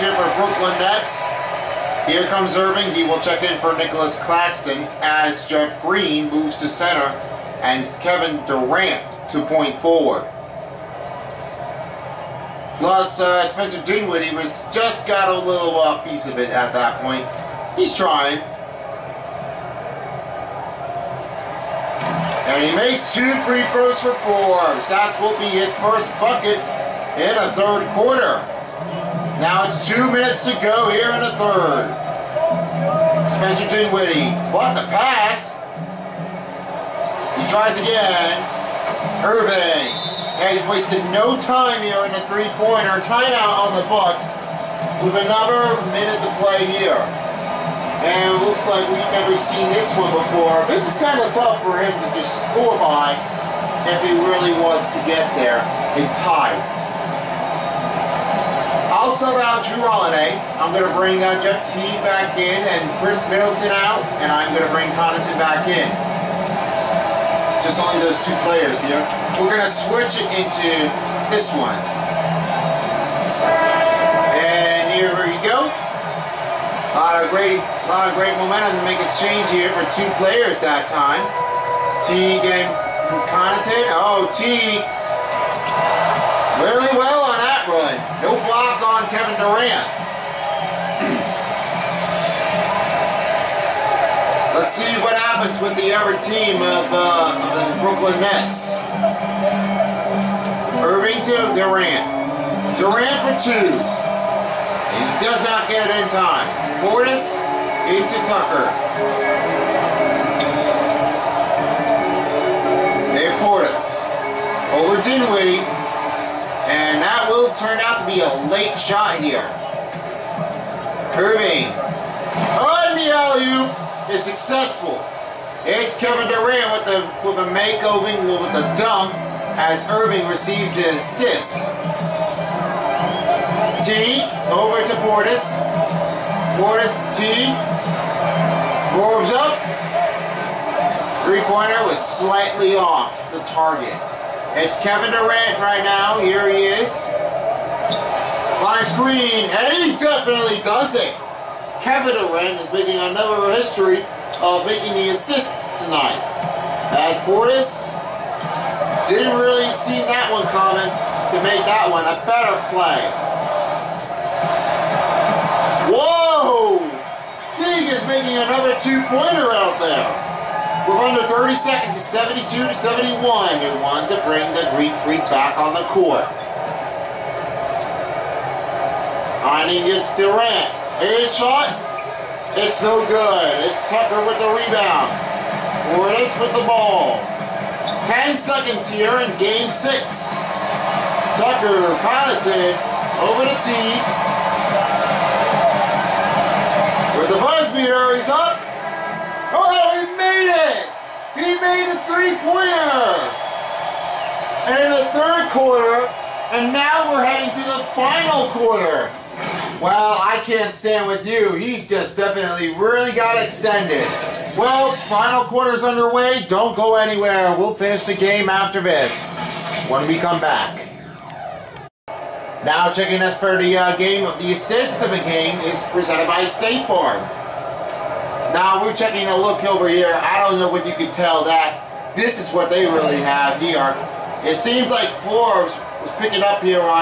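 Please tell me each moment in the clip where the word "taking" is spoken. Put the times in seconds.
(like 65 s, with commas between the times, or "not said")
228 s.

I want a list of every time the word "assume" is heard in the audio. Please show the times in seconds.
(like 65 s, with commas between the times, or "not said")
not said.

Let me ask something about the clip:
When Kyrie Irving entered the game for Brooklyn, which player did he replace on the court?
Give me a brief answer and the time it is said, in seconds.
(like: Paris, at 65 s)
Nicolas Claxton, at 3 s.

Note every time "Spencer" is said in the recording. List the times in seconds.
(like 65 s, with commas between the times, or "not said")
13 s, 33 s.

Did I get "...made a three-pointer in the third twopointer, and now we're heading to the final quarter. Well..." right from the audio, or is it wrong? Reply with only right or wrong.
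wrong.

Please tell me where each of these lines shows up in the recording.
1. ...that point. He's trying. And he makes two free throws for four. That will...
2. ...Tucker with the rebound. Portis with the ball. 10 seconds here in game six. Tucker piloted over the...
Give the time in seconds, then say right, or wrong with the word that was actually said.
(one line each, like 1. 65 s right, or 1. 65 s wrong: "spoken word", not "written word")
1. 16 s right
2. 183 s right.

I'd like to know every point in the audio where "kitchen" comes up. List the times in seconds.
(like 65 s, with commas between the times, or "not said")
not said.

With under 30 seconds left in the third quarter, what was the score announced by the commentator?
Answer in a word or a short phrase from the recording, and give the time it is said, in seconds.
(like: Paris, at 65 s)
72 to 71, at 171 s.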